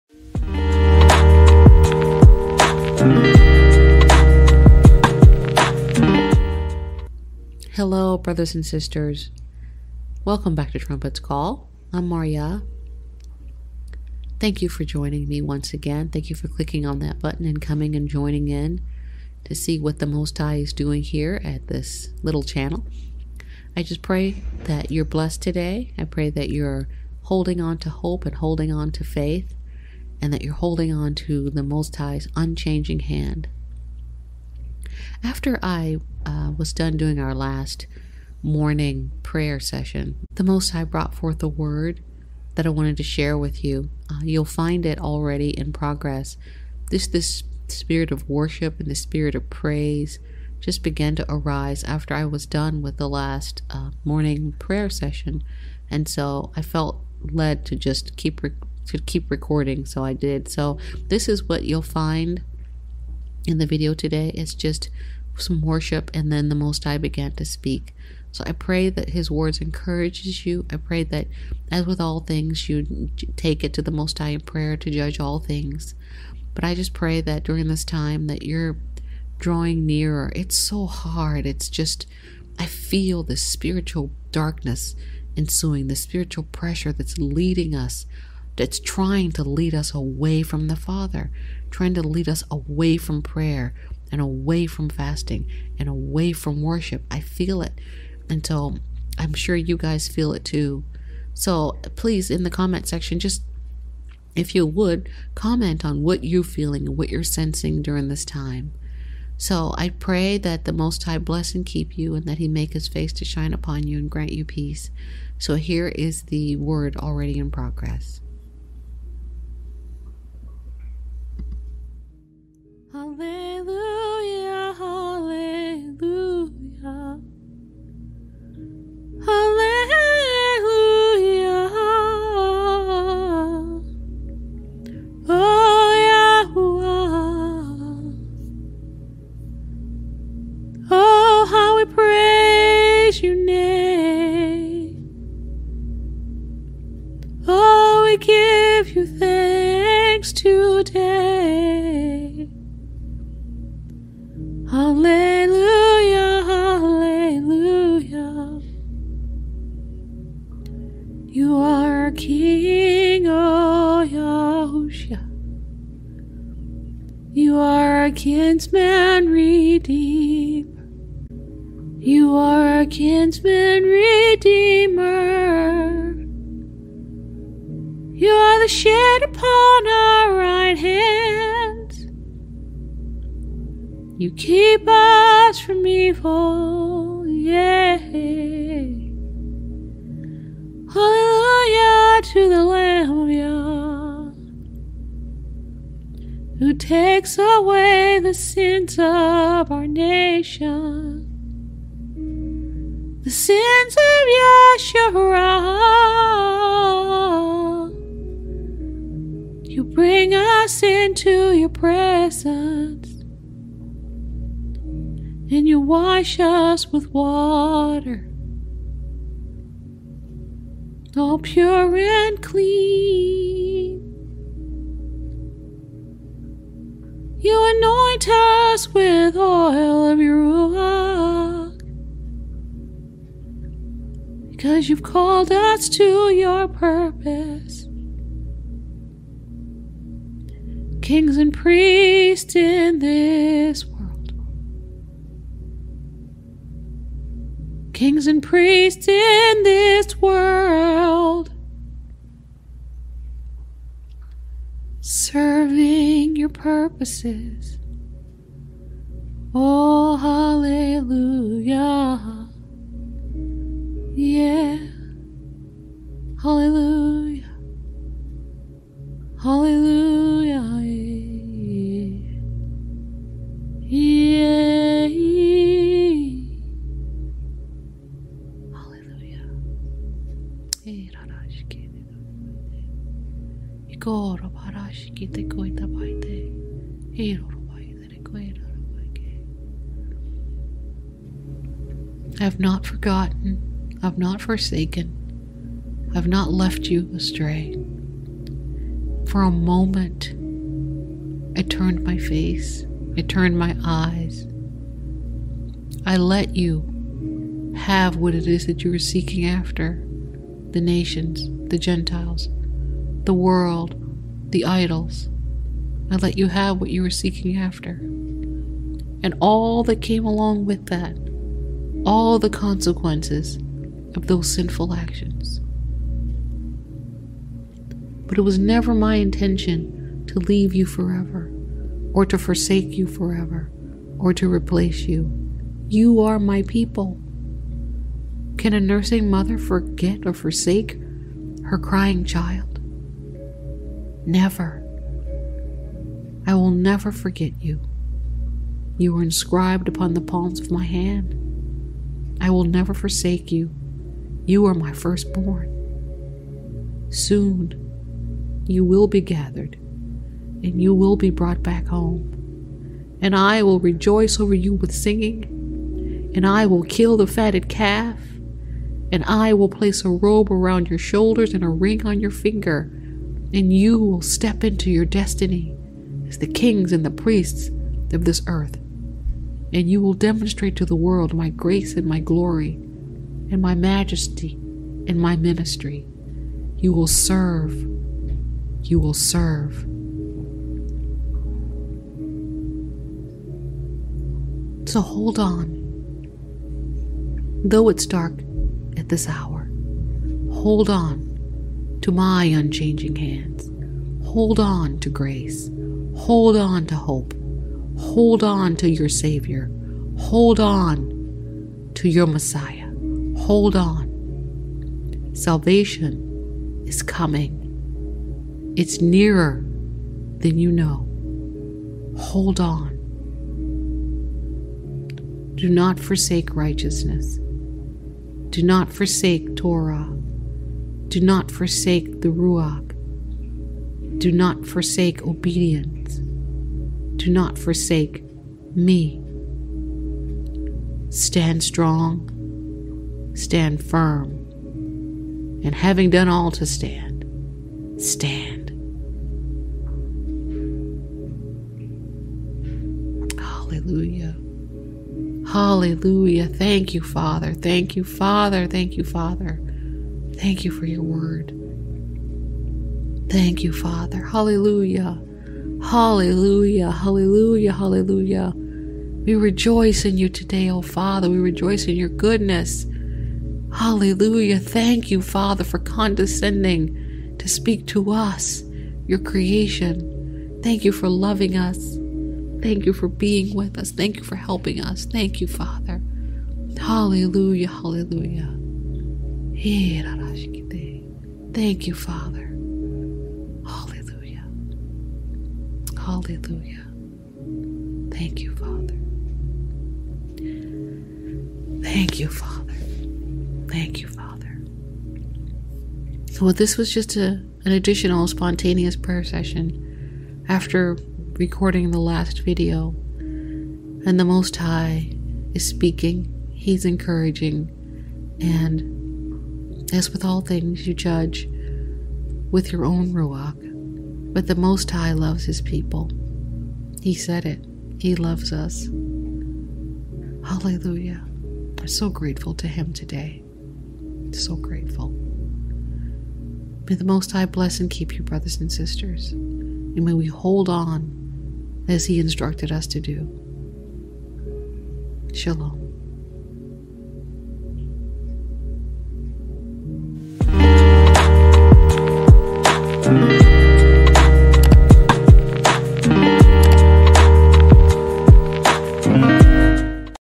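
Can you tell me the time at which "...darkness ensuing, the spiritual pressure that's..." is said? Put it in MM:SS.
01:24.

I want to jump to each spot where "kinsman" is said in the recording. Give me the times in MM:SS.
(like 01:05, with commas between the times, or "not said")
02:48, 02:52.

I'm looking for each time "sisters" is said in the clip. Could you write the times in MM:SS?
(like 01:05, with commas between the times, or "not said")
00:08, 08:58.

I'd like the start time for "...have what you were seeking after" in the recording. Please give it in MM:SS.
05:16.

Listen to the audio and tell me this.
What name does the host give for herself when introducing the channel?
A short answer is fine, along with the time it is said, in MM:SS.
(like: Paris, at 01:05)
MarYaH, at 00:12.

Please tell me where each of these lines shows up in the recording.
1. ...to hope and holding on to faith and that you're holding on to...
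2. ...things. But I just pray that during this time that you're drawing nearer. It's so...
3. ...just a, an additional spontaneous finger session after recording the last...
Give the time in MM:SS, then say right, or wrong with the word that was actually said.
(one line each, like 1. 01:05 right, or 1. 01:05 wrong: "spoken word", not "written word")
1. 00:27 right
2. 01:15 right
3. 08:26 wrong: "prayer", not "finger".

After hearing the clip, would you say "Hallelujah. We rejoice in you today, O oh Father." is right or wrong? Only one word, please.
right.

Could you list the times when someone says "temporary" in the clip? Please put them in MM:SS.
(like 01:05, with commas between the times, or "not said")
not said.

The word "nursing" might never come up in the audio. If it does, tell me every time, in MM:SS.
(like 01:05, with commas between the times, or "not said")
05:38.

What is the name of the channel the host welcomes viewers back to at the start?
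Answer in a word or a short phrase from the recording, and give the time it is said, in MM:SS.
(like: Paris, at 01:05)
Trumpet's Call, at 00:10.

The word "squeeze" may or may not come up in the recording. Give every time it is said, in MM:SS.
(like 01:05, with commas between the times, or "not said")
not said.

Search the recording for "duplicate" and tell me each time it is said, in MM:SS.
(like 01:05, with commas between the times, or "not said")
not said.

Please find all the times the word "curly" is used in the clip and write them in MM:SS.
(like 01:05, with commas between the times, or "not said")
not said.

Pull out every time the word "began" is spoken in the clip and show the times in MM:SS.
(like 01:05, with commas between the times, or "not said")
00:50, 01:06.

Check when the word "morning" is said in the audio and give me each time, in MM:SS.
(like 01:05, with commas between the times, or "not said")
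00:38, 00:54.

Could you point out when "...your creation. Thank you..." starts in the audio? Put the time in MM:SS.
07:59.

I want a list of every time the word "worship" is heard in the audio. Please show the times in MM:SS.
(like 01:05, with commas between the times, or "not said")
00:48, 01:05, 01:36.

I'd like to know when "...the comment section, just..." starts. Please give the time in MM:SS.
01:42.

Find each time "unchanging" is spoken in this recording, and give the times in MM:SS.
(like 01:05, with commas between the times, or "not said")
00:32, 06:42.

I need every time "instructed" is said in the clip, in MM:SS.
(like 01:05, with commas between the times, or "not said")
09:02.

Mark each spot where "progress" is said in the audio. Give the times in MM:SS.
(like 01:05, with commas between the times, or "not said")
00:45, 01:57.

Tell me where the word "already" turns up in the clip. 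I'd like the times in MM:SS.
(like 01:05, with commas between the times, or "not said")
00:44, 01:56.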